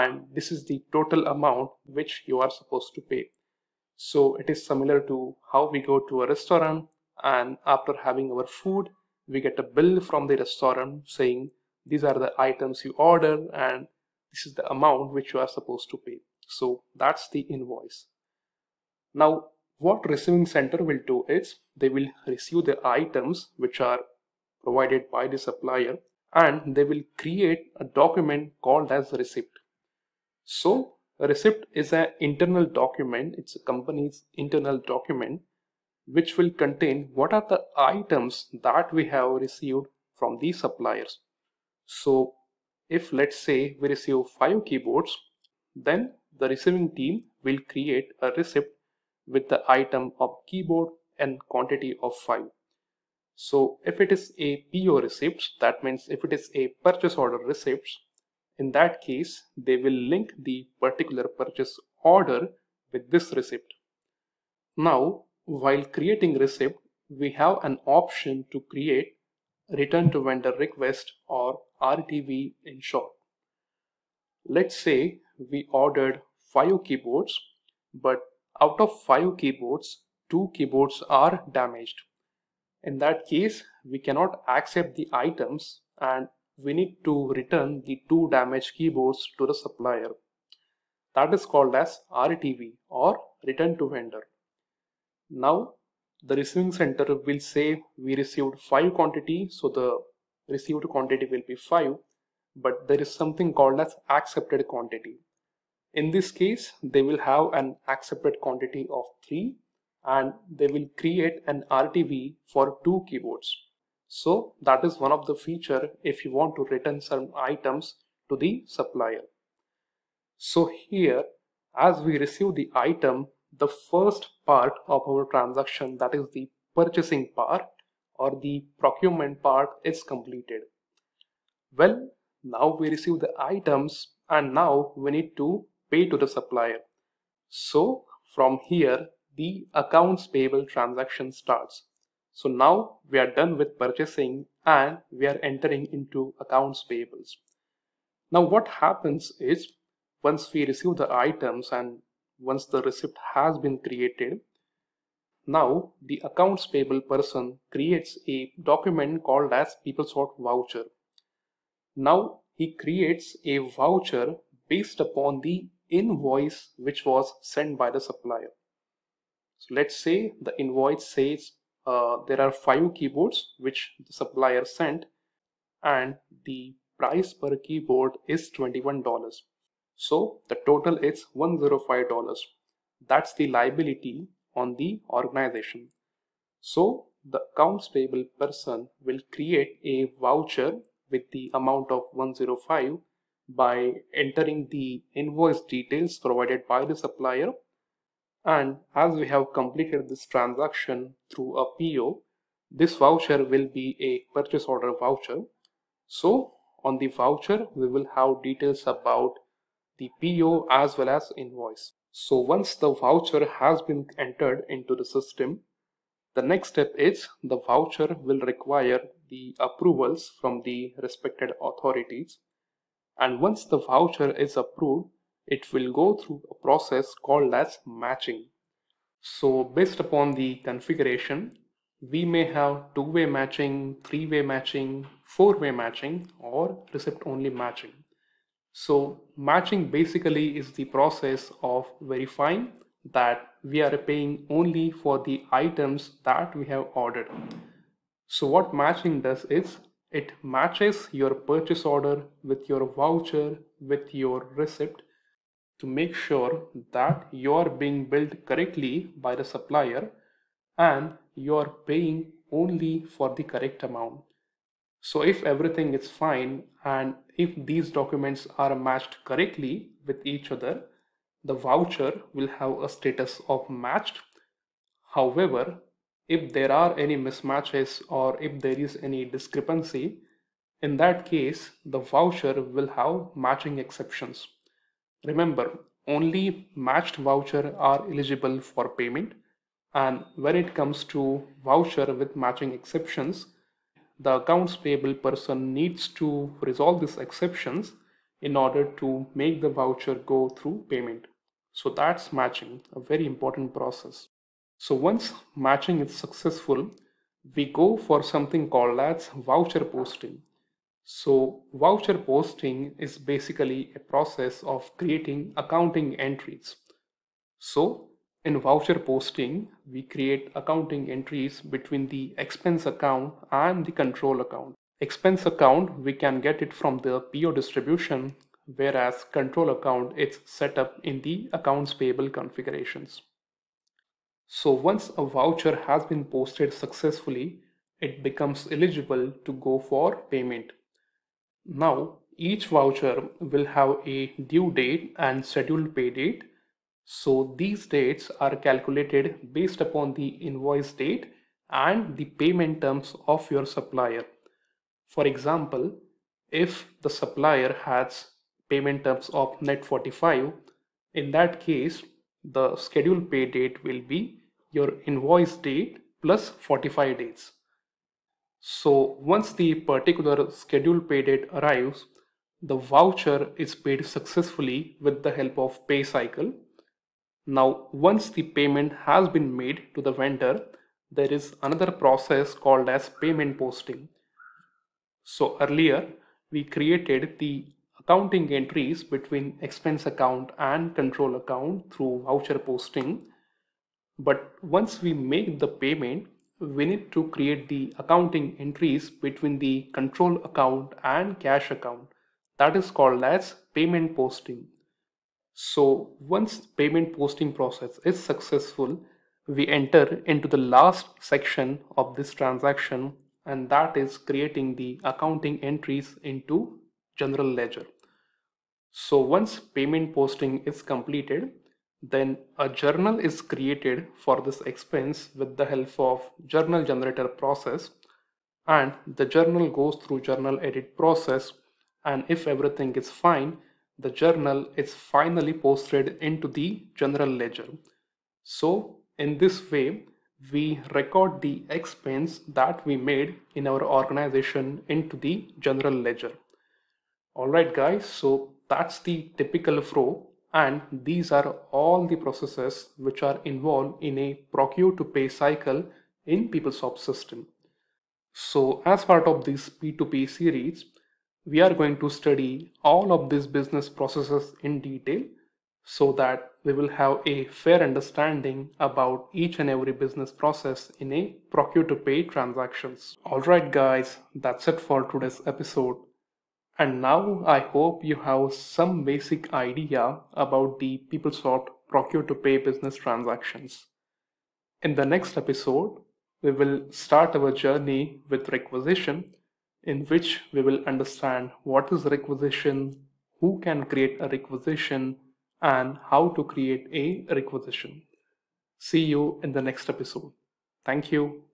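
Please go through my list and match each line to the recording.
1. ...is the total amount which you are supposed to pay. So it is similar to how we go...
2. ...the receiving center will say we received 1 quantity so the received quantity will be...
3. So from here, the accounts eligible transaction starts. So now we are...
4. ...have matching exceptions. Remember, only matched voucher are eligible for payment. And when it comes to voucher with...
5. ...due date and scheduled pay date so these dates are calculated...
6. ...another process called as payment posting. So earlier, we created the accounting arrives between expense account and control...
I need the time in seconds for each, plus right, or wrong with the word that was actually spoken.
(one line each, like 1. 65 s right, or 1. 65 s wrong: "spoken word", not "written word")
1. 0 s right
2. 96 s wrong: "5", not "1"
3. 137 s wrong: "payable", not "eligible"
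4. 282 s right
5. 344 s right
6. 381 s wrong: "entries", not "arrives".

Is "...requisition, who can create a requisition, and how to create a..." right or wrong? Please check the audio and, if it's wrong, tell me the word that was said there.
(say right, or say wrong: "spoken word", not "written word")
right.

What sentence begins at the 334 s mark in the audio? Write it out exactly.
So once a voucher has been posted successfully, it becomes eligible to go for payment.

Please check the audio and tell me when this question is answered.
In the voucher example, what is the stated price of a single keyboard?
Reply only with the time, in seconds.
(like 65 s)
178 s.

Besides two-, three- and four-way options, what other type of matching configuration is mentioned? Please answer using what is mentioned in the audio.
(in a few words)
receipt-only matching.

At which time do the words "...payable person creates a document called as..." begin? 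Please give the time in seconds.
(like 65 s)
156 s.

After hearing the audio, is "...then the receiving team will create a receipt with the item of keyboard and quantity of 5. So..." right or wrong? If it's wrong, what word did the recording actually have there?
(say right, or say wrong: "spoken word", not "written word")
right.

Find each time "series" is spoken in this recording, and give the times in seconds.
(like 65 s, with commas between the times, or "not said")
460 s.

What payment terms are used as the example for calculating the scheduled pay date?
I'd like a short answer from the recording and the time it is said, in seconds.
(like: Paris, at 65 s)
net 45, at 359 s.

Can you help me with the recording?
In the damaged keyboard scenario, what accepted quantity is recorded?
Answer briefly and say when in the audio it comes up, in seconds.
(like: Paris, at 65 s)
3, at 107 s.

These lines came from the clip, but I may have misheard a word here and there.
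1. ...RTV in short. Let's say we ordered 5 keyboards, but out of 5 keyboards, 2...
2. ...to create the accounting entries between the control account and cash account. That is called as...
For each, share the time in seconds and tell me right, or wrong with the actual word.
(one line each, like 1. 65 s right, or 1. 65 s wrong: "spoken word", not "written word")
1. 71 s right
2. 397 s right.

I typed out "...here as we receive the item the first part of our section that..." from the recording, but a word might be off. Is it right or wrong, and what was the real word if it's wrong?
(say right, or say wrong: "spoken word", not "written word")
wrong: "transaction", not "section".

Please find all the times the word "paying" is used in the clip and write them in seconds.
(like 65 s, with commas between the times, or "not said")
243 s, 261 s.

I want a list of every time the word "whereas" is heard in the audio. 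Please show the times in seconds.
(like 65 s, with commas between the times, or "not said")
328 s.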